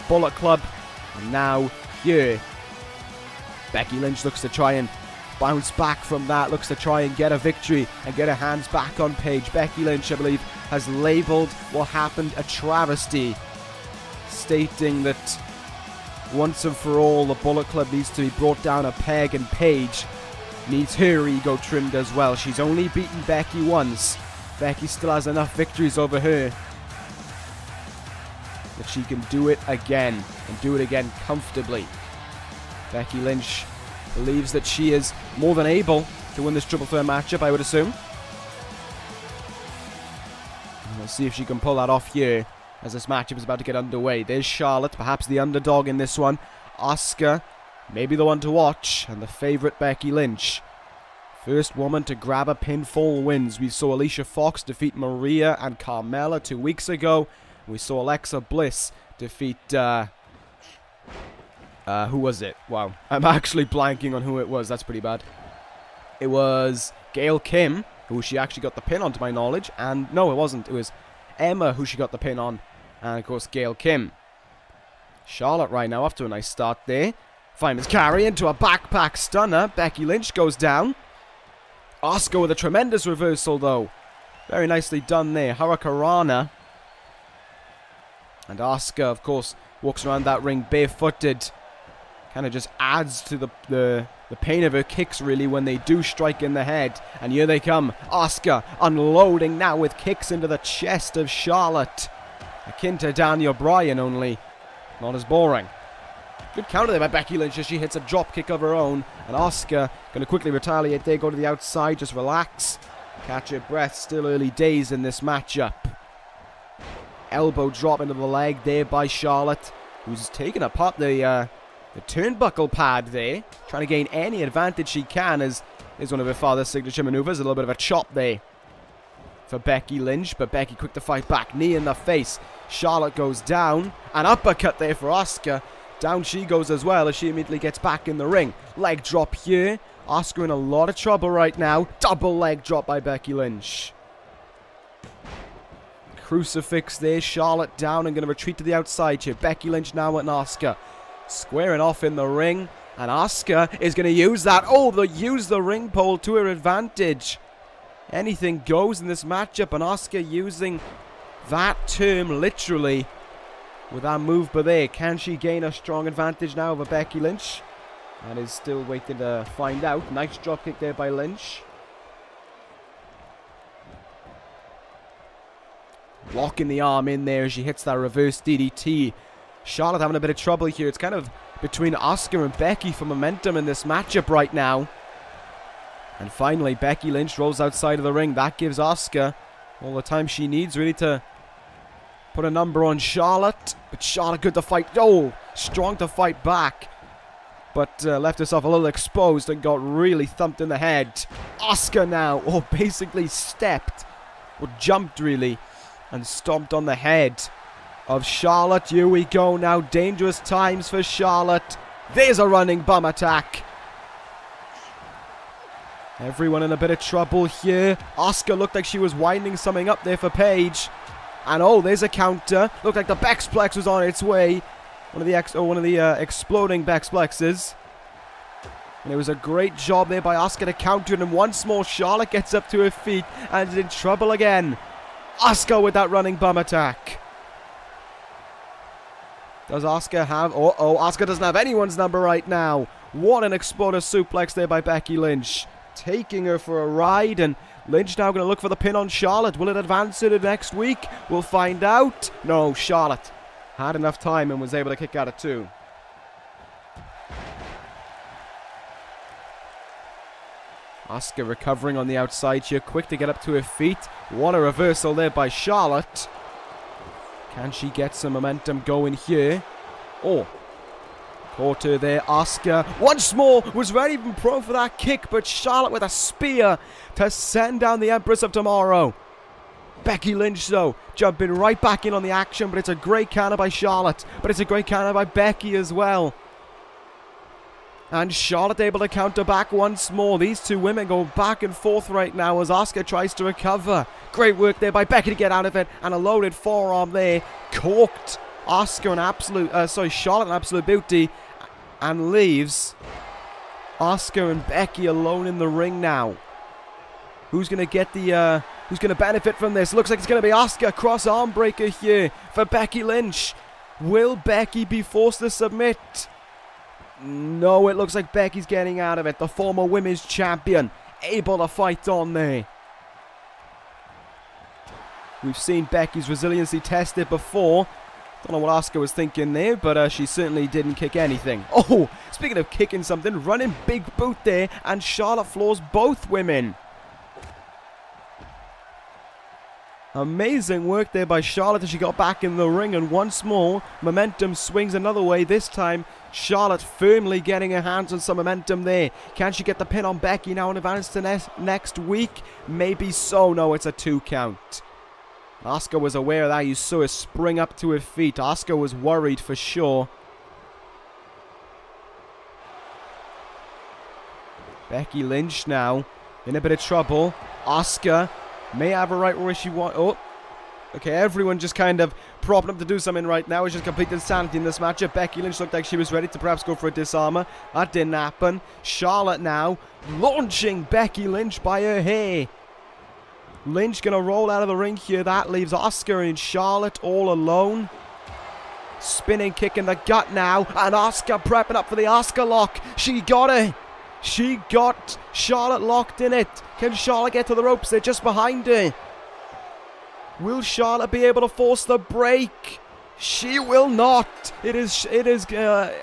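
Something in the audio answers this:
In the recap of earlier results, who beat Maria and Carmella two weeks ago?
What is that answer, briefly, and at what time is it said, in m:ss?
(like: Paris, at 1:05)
Alicia Fox, at 0:53.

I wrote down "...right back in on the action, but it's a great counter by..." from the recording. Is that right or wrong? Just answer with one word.
right.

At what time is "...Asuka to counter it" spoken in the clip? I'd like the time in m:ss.
3:50.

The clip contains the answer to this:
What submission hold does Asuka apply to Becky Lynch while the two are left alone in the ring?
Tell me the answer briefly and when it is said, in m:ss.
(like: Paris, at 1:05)
Cross arm breaker, at 5:10.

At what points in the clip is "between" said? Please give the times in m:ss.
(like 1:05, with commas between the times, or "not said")
3:01.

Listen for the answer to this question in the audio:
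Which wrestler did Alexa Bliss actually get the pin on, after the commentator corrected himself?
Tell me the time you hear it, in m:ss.
1:10.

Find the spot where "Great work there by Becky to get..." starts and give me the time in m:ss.
4:54.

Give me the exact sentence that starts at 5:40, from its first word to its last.
Amazing work there by Charlotte as she got back in the ring, and once more, momentum swings another way.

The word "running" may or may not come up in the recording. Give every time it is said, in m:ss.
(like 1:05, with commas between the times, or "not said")
3:32, 3:56, 5:33.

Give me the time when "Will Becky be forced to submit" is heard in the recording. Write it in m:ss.
5:14.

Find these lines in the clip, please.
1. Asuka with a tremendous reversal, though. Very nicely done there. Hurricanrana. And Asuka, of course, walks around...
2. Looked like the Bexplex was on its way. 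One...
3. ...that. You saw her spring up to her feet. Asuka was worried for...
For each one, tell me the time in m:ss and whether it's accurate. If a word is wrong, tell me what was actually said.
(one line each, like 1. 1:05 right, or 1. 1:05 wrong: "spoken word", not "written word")
1. 1:22 right
2. 3:42 right
3. 5:56 right.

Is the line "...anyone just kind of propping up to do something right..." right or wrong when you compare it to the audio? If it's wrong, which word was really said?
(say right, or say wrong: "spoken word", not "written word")
wrong: "everyone", not "anyone".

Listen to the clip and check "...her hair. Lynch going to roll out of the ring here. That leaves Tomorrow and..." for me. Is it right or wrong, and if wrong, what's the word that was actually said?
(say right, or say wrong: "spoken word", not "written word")
wrong: "Asuka", not "Tomorrow".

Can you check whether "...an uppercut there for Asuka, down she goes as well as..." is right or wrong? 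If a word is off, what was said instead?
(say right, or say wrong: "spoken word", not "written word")
right.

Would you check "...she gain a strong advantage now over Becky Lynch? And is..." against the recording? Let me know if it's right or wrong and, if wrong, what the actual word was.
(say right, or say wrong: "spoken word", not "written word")
right.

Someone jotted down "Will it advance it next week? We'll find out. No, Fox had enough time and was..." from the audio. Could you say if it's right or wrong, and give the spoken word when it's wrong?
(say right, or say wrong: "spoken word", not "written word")
wrong: "Charlotte", not "Fox".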